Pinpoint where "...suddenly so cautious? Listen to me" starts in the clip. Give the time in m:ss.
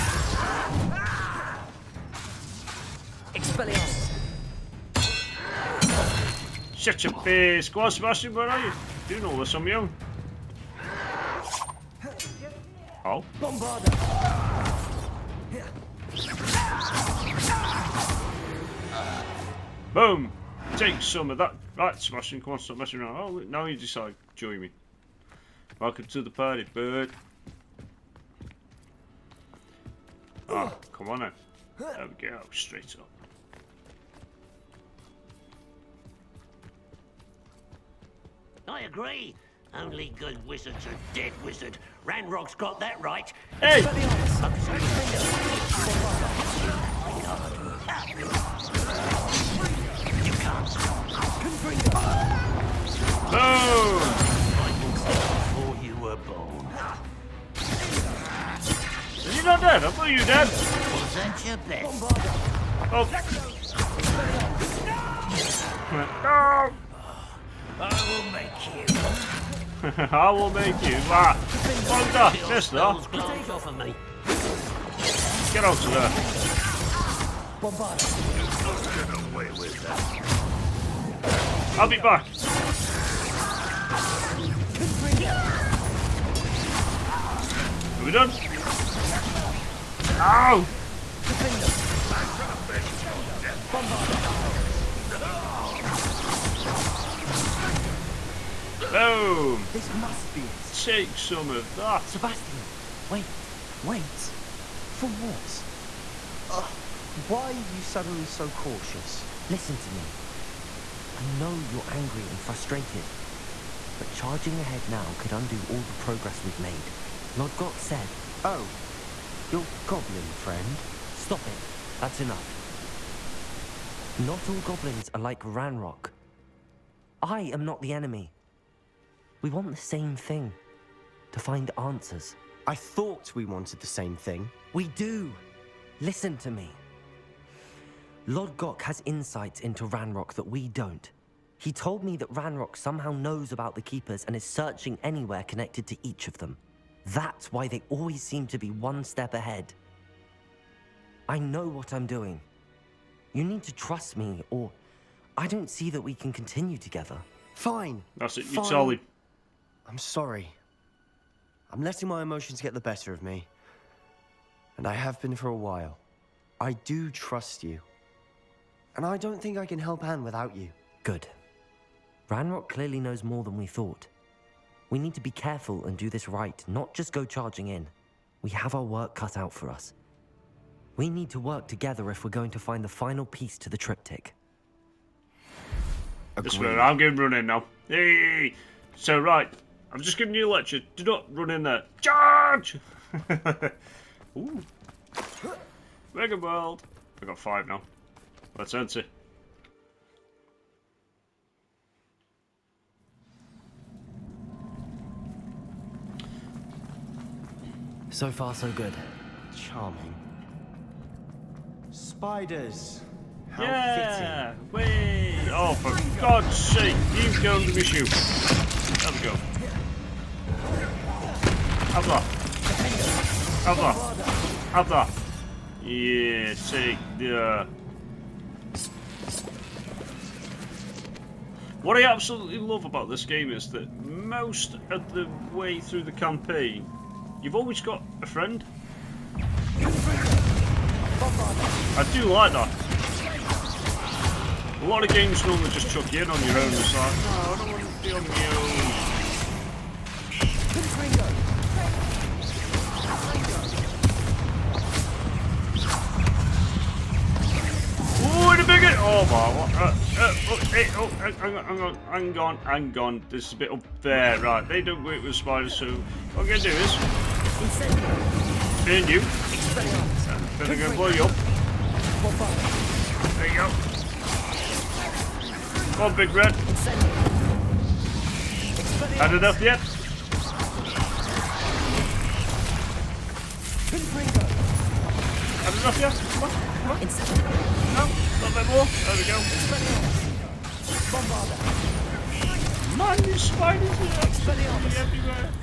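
1:47.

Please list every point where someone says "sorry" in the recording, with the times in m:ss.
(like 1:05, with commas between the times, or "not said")
2:39.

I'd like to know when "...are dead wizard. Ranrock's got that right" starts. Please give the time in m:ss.
0:40.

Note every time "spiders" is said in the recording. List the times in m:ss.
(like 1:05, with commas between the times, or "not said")
3:31, 4:25, 4:53.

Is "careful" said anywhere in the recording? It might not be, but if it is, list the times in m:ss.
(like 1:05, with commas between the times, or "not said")
2:55.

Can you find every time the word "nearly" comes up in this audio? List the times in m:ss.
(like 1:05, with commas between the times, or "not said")
not said.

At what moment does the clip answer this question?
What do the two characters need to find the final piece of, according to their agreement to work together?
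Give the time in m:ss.
3:03.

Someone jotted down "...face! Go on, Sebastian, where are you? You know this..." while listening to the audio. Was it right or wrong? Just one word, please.
right.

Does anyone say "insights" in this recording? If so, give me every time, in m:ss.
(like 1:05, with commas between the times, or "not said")
2:19.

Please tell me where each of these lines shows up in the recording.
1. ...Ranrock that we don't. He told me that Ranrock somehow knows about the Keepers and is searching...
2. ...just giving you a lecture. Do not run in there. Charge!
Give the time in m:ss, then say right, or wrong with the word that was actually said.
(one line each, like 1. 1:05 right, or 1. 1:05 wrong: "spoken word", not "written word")
1. 2:19 right
2. 3:10 right.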